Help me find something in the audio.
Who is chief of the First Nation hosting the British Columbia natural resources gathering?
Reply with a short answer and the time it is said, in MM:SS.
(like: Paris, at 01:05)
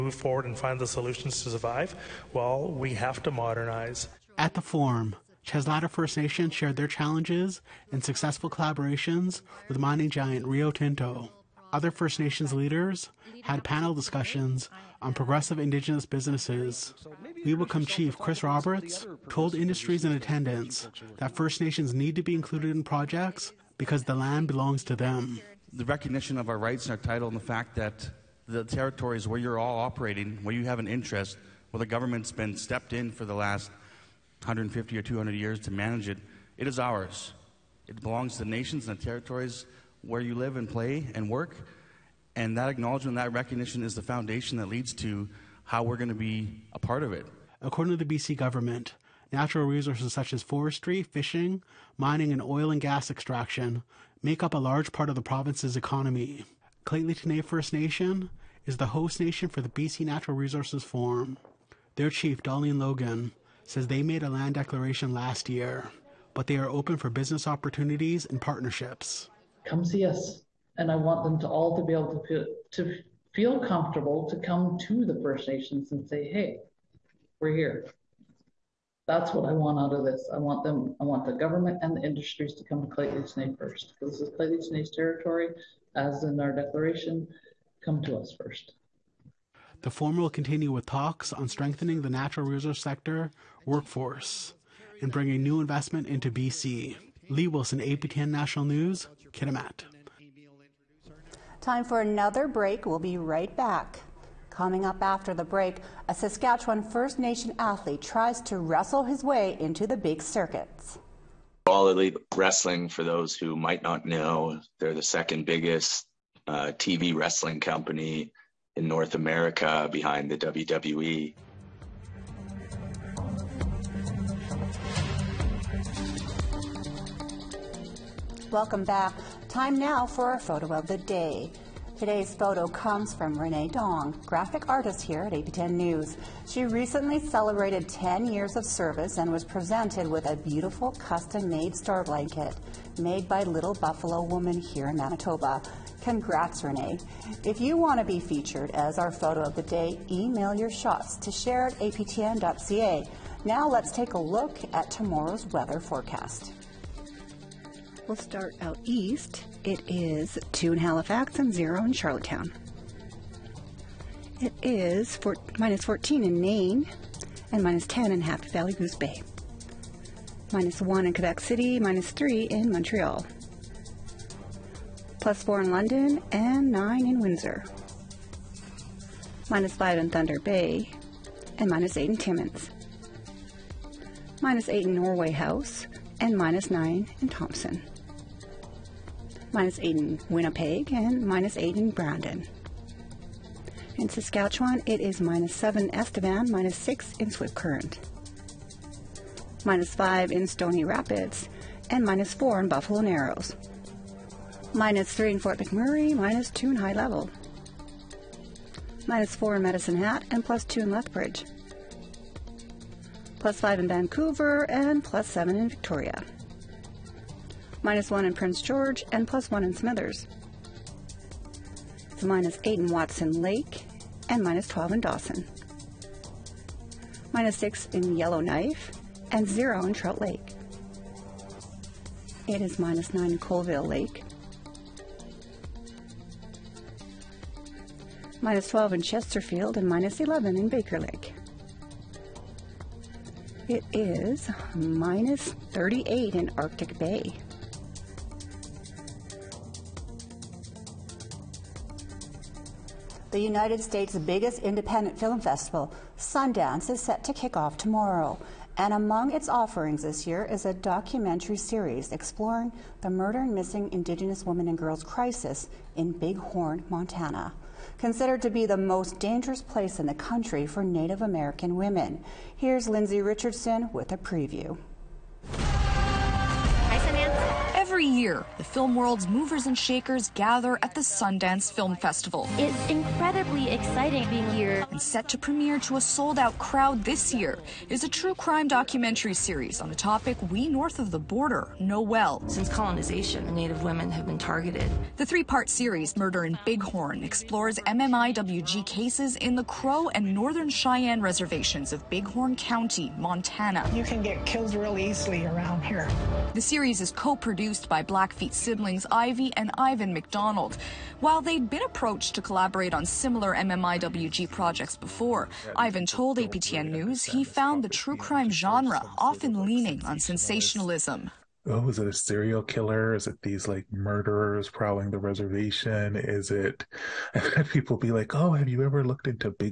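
Dolleen Logan, at 01:02.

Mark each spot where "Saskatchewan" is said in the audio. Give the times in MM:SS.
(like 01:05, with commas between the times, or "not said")
01:46, 03:14.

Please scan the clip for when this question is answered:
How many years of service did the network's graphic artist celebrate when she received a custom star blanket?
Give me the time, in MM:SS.
02:17.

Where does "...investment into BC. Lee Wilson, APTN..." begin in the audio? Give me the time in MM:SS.
01:35.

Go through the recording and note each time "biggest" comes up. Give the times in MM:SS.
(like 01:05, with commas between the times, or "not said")
01:55, 04:14.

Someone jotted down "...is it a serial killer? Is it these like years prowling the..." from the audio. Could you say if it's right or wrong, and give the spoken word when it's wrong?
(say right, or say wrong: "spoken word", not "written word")
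wrong: "murderers", not "years".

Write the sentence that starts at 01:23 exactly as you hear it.
This is Lheidli T'enneh's territory, as in our declaration, come to us first.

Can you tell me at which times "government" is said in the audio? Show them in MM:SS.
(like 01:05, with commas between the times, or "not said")
00:31, 00:48, 01:21.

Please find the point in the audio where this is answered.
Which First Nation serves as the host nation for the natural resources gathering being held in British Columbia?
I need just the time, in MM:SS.
00:56.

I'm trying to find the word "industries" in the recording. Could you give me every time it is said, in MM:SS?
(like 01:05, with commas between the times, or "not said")
00:19, 01:22.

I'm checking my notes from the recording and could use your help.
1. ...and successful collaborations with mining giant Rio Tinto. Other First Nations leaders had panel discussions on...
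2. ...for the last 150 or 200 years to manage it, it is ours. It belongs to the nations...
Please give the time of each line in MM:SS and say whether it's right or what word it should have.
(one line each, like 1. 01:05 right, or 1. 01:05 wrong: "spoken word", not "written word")
1. 00:07 right
2. 00:33 right.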